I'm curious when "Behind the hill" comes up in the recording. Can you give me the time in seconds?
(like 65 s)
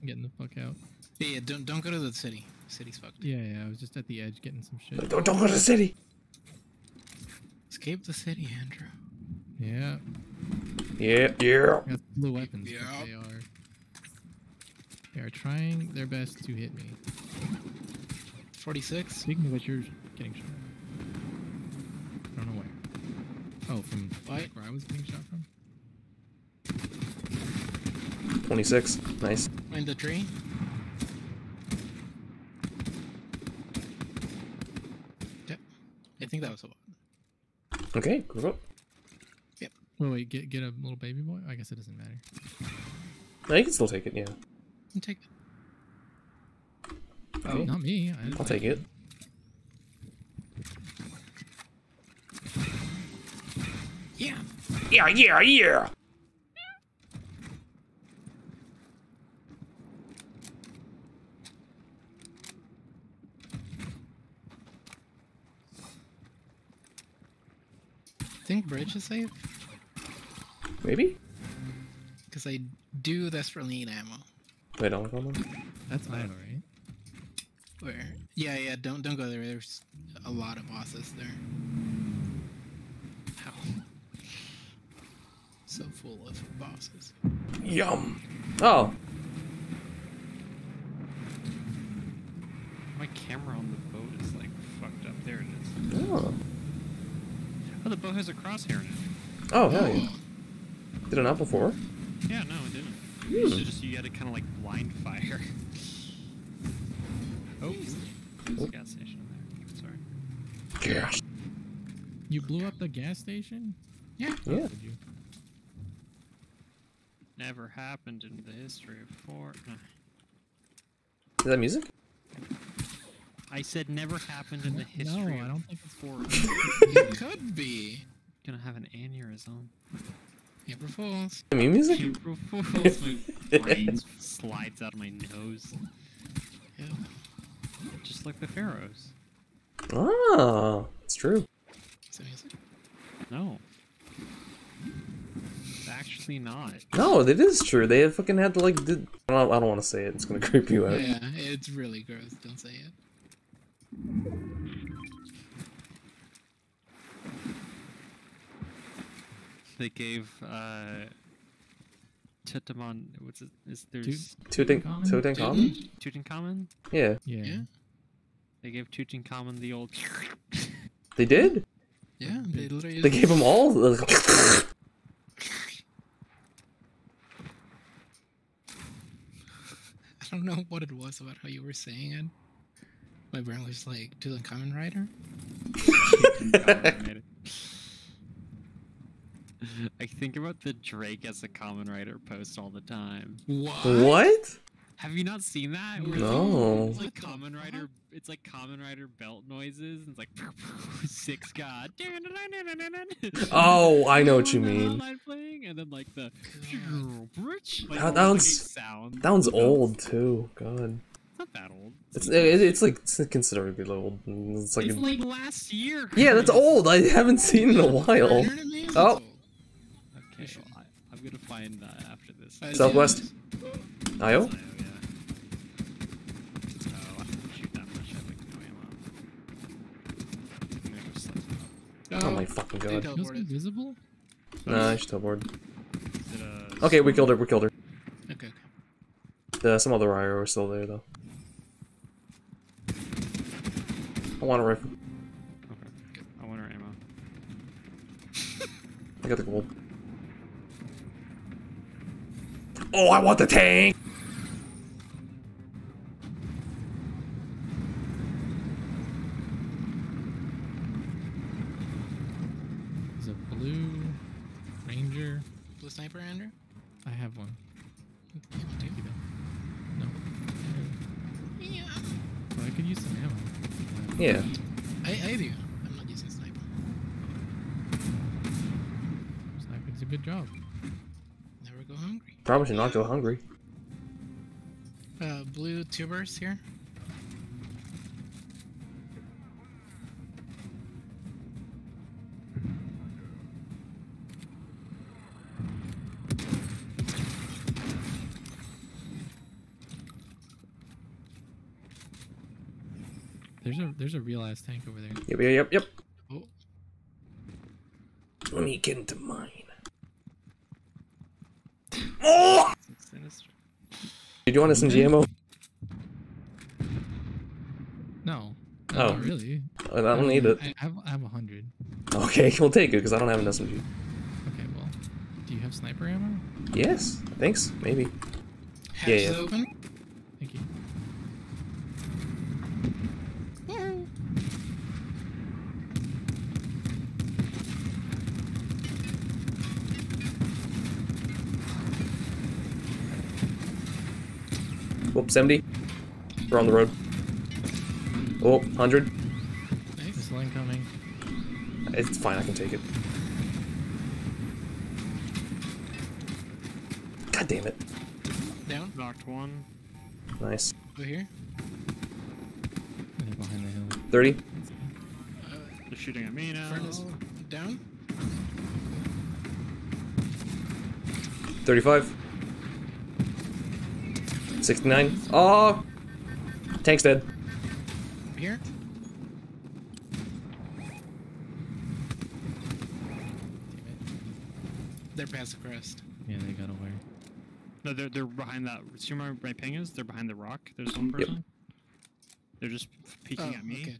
363 s.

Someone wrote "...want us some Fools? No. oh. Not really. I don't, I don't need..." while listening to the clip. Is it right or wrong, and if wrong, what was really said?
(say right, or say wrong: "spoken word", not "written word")
wrong: "GMO", not "Fools".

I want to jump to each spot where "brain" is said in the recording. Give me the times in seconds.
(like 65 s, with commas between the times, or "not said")
133 s, 183 s.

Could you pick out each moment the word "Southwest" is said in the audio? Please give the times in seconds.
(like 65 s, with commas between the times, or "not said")
222 s.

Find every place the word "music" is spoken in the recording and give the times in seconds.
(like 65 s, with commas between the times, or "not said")
121 s, 131 s.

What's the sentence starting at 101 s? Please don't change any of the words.
did it not before yeah no it didn't hmm.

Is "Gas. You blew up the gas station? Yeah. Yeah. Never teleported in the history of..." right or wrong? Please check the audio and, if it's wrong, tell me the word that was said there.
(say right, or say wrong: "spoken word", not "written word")
wrong: "happened", not "teleported".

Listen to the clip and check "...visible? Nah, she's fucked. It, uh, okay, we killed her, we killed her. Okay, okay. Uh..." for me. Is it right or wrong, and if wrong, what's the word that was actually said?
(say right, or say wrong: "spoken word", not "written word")
wrong: "teleported", not "fucked".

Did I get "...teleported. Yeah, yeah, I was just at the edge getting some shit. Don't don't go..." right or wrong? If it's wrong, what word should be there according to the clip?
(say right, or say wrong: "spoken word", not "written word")
wrong: "fucked", not "teleported".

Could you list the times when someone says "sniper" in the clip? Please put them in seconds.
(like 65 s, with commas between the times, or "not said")
265 s, 325 s.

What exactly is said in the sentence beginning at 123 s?
I said never happened in the history.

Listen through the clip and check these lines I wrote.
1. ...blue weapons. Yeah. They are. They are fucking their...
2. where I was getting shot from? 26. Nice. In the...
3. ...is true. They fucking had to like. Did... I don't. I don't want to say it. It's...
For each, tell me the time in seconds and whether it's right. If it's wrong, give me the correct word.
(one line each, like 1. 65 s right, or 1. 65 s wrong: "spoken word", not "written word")
1. 12 s wrong: "trying", not "fucking"
2. 24 s right
3. 147 s right.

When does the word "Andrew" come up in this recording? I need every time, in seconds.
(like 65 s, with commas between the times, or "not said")
8 s, 266 s.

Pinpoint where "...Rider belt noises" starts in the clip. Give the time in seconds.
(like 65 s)
198 s.